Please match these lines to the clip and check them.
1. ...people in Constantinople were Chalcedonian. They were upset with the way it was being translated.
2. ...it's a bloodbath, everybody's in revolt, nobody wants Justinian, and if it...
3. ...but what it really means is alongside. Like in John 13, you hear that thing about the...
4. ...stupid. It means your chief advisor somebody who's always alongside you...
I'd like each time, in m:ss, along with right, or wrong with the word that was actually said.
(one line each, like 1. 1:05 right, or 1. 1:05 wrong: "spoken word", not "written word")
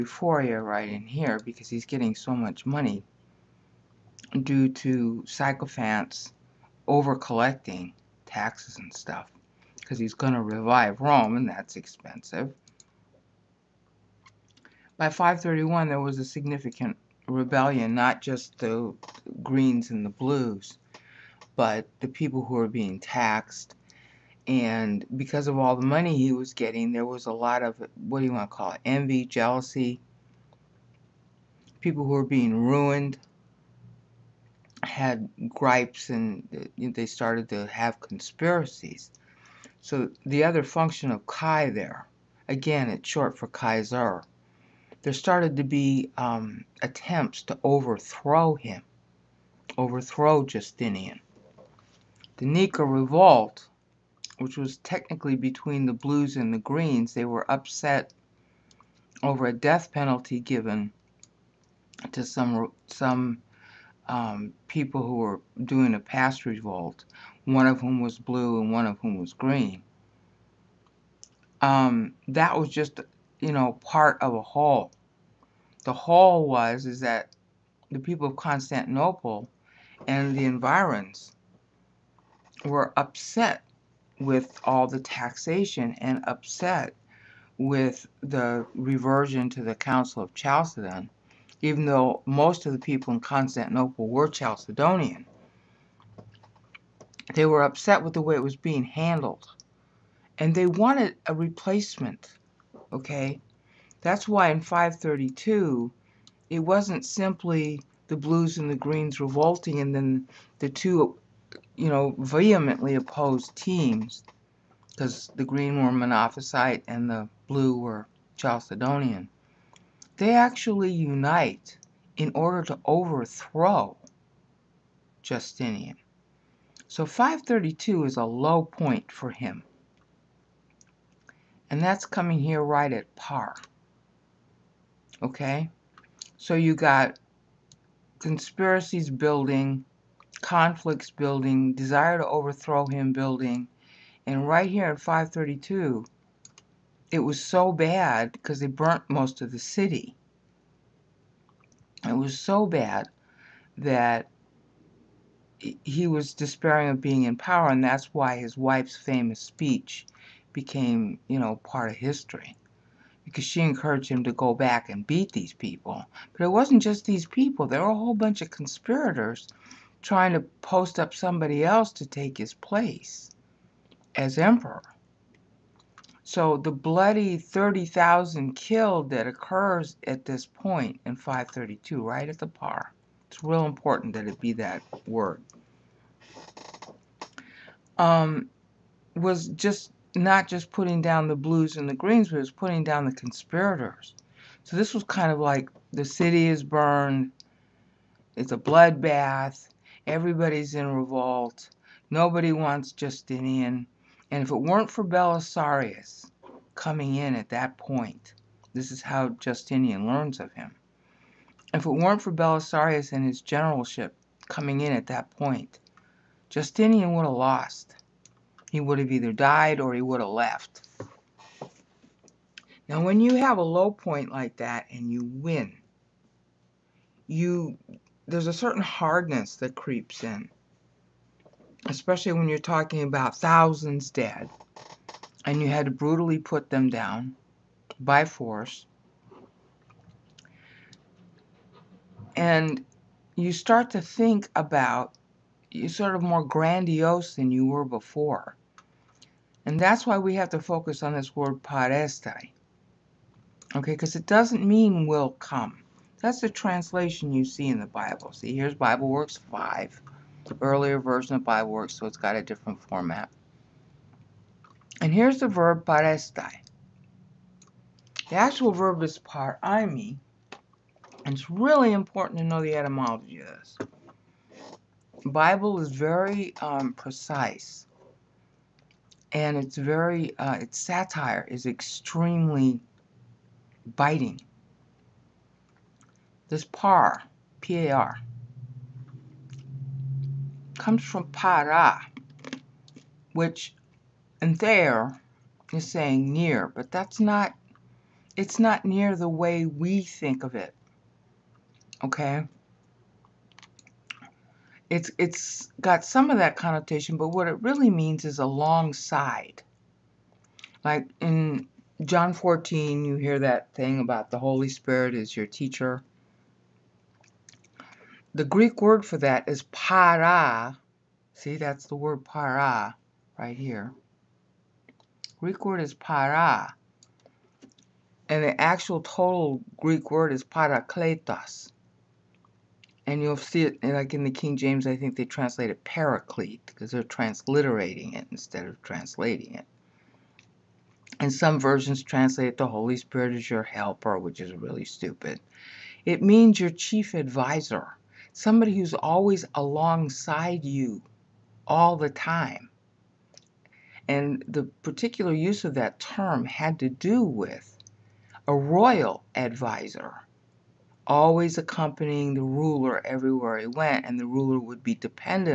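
1. 1:32 wrong: "handled", not "translated"
2. 3:18 right
3. 5:07 wrong: "14", not "13"
4. 5:44 right.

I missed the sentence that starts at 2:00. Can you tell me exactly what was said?
They actually unite in order to overthrow Justinian.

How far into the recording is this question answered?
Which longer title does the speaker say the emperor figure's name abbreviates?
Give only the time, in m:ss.
0:43.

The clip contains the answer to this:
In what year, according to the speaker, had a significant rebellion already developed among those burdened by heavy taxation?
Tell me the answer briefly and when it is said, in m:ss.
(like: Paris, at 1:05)
531, at 0:15.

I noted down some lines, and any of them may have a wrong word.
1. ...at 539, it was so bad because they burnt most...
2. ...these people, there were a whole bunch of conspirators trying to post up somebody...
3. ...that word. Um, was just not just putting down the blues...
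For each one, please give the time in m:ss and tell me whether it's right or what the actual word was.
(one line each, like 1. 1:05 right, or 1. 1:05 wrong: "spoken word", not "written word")
1. 2:24 wrong: "532", not "539"
2. 2:47 right
3. 3:04 right.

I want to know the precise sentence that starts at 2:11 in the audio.
And that's coming here right at par.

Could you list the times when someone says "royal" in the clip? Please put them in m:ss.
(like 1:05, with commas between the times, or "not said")
5:58.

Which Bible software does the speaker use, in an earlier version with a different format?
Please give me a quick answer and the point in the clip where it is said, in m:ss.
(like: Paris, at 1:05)
BibleWorks 5, at 4:18.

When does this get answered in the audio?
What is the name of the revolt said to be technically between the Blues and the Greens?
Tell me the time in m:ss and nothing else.
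0:52.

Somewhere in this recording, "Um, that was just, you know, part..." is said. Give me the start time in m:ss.
1:11.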